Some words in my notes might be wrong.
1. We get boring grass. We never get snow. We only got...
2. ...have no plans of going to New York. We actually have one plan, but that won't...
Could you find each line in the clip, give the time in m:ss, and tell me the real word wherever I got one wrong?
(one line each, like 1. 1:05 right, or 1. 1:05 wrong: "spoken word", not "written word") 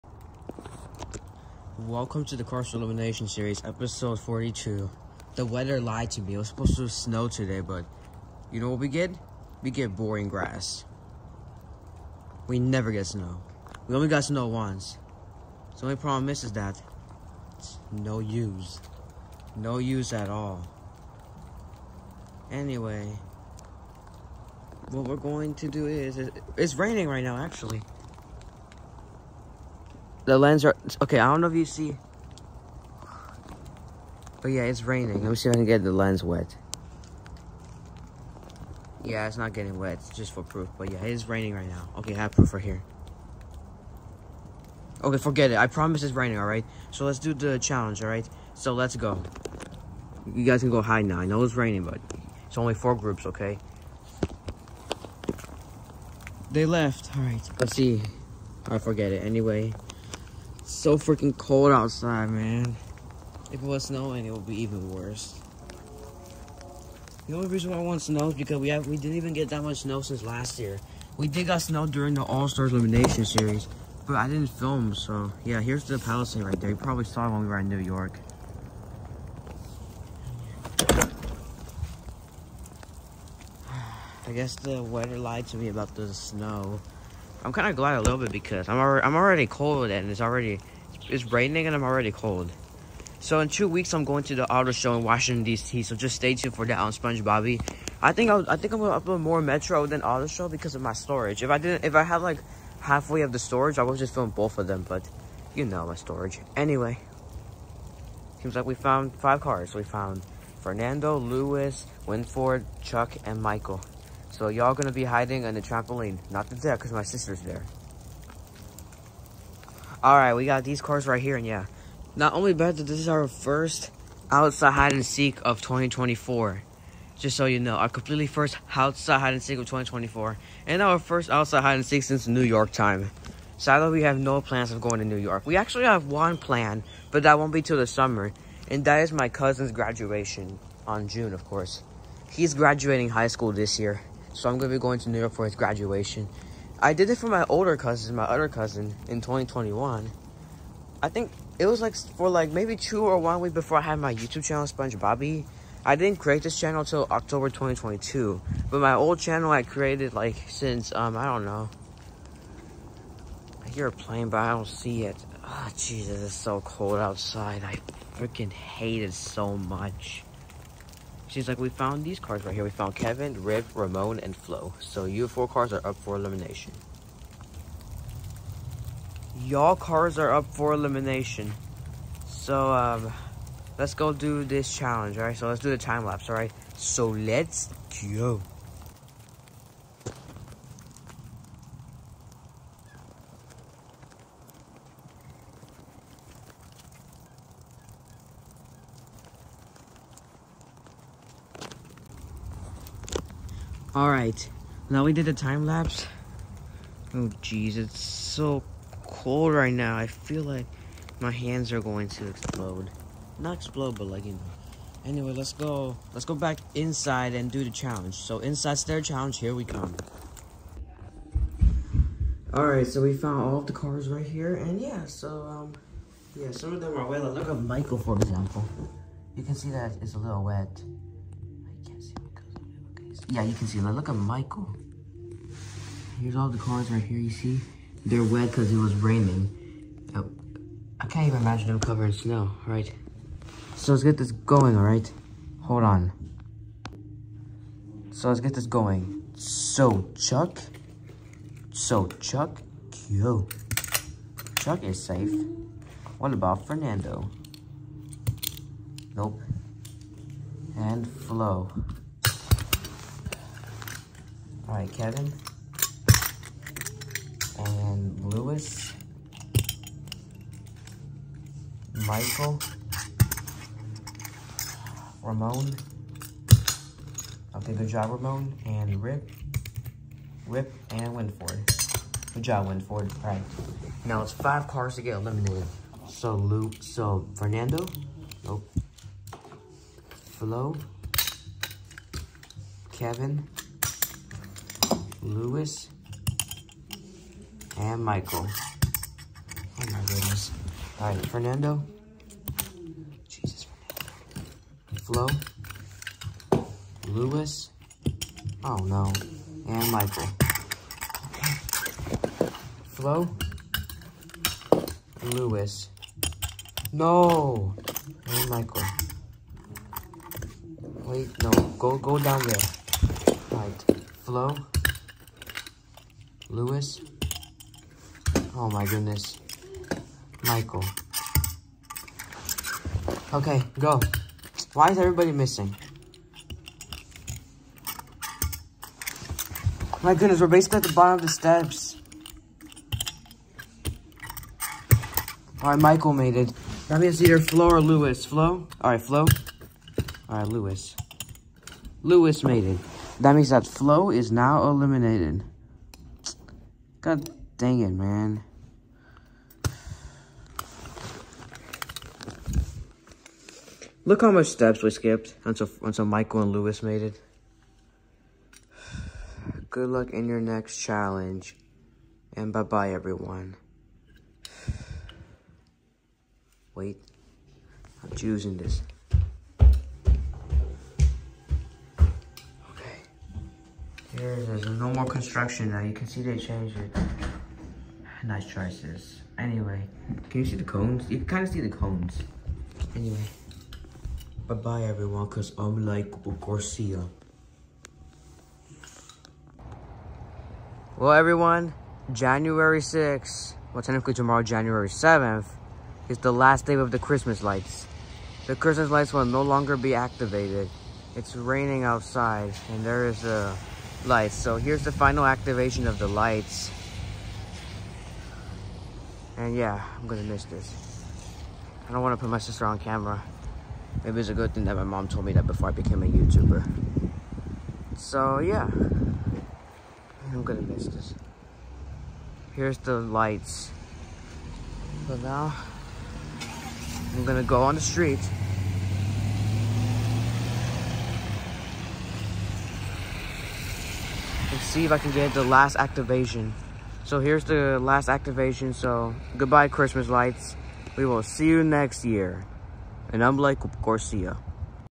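1. 0:09 right
2. 2:14 right.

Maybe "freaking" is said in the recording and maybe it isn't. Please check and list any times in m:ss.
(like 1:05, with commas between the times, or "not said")
1:00, 2:48.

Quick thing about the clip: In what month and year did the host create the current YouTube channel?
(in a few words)
October 2022.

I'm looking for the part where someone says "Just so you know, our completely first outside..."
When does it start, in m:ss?
2:07.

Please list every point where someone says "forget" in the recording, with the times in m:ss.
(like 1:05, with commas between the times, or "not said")
0:45, 0:58.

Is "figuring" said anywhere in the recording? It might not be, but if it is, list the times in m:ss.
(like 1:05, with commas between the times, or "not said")
not said.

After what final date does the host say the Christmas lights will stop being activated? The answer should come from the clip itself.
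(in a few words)
January 7th.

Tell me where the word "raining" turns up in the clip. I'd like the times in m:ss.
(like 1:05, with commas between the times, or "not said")
0:26, 0:34, 0:41, 0:46, 0:51, 1:31, 3:58, 6:51.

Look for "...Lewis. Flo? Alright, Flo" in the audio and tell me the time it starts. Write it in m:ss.
5:47.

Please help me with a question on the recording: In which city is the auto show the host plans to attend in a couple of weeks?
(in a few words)
Washington D.C.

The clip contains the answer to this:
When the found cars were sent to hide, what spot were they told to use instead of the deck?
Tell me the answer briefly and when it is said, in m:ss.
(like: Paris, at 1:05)
The trampoline, at 1:55.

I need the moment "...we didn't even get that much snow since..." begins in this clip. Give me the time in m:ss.
1:08.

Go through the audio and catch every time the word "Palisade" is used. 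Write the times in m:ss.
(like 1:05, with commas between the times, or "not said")
1:15.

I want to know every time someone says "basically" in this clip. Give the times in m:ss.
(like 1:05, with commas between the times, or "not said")
5:40.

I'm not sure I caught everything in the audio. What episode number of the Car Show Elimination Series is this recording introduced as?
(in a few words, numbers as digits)
42.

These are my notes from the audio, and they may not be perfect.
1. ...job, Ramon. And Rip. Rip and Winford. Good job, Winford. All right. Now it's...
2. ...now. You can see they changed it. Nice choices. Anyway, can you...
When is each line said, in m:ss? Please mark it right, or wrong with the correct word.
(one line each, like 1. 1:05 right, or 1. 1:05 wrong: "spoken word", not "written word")
1. 4:37 right
2. 6:25 right.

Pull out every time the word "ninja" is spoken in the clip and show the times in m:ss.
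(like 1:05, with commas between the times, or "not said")
not said.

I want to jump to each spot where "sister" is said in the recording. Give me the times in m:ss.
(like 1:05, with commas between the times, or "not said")
1:57, 7:02.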